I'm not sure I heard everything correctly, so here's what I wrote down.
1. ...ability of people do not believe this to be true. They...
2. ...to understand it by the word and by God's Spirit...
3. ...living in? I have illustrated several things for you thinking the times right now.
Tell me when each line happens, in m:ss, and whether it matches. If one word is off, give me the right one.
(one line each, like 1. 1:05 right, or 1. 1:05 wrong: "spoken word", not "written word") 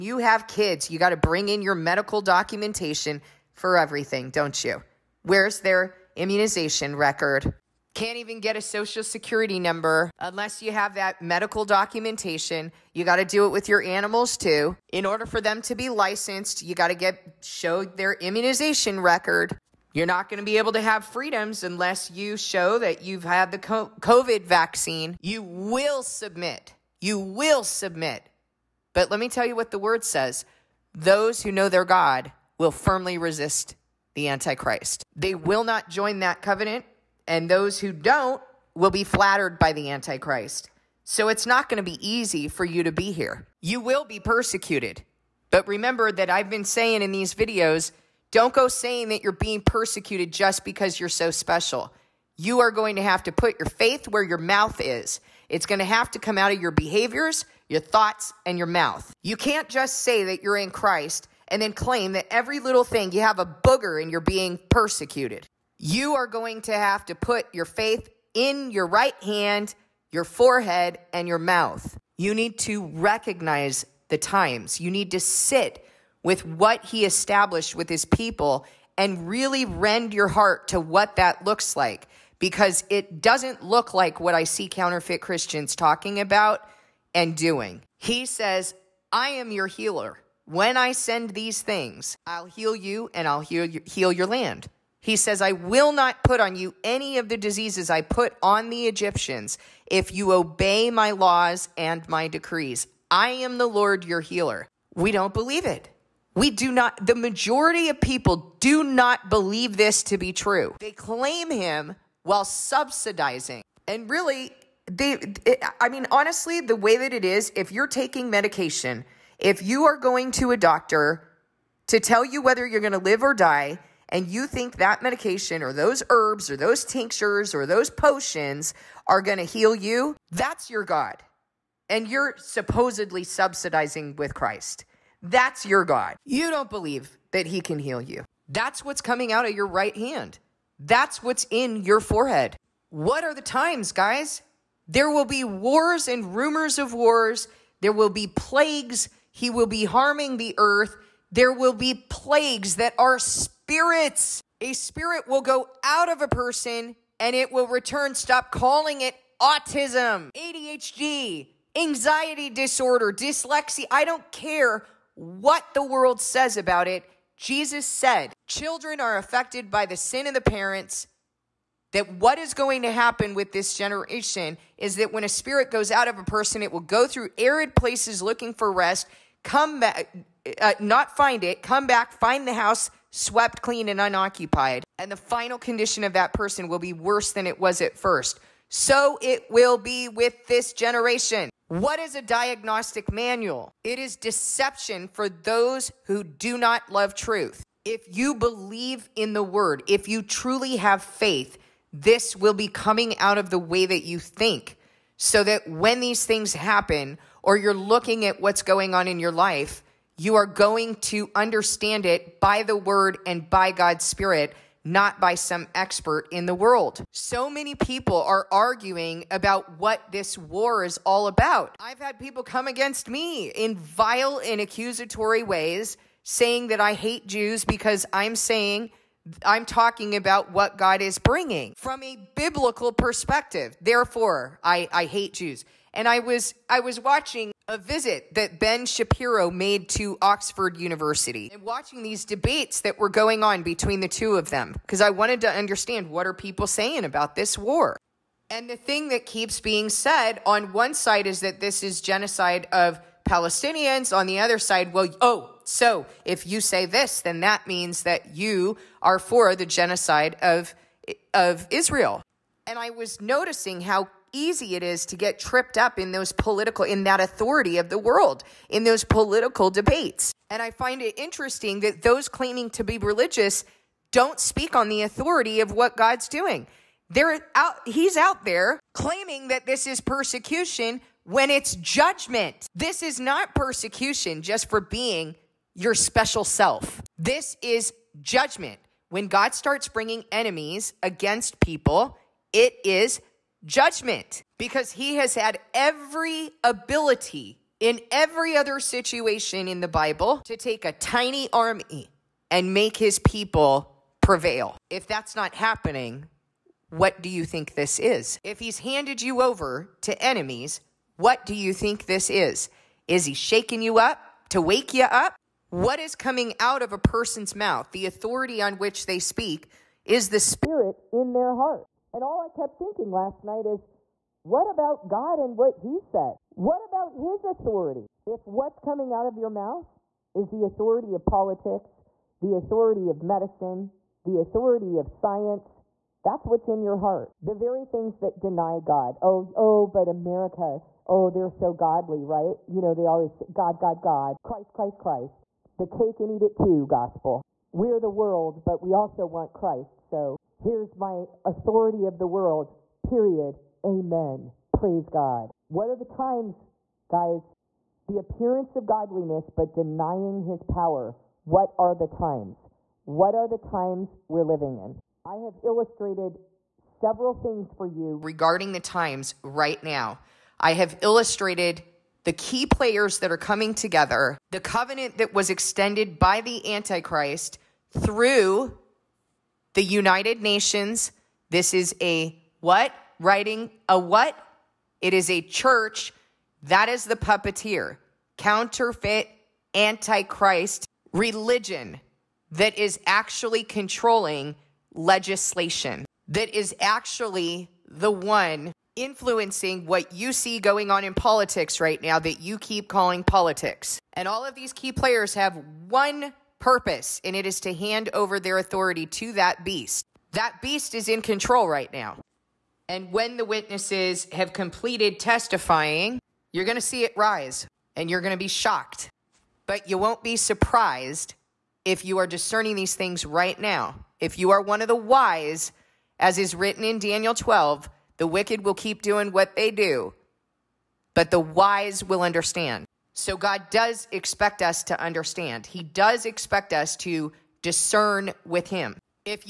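1. 1:47 wrong: "majority", not "ability"
2. 3:30 right
3. 6:04 wrong: "regarding", not "thinking".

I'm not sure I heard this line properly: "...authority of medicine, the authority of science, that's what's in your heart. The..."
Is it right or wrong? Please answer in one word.
right.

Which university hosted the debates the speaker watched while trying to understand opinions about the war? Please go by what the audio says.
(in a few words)
Oxford University.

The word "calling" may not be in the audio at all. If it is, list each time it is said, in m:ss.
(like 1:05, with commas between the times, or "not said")
2:38, 6:42.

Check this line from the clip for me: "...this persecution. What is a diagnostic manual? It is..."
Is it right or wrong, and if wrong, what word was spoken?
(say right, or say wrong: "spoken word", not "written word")
wrong: "generation", not "persecution".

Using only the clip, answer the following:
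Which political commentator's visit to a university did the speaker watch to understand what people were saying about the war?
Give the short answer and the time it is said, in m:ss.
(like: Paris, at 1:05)
Ben Shapiro, at 3:58.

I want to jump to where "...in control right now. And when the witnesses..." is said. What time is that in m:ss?
6:51.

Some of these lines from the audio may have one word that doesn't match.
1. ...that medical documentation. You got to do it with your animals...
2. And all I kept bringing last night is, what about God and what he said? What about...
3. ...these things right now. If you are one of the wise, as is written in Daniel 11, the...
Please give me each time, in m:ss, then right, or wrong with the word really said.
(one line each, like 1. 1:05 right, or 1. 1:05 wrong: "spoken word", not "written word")
1. 0:10 right
2. 5:22 wrong: "thinking", not "bringing"
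3. 7:02 wrong: "12", not "11".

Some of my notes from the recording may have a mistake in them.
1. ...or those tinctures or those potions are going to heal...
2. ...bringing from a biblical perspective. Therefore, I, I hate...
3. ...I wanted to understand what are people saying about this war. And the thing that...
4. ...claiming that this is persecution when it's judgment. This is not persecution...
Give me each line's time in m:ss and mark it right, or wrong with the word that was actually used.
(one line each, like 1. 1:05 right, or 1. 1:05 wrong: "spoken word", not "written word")
1. 2:06 right
2. 3:51 right
3. 4:04 right
4. 4:38 right.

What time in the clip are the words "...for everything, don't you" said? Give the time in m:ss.
0:03.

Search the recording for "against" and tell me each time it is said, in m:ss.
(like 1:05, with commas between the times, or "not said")
3:42, 4:51.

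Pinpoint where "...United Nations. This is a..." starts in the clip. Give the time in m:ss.
6:19.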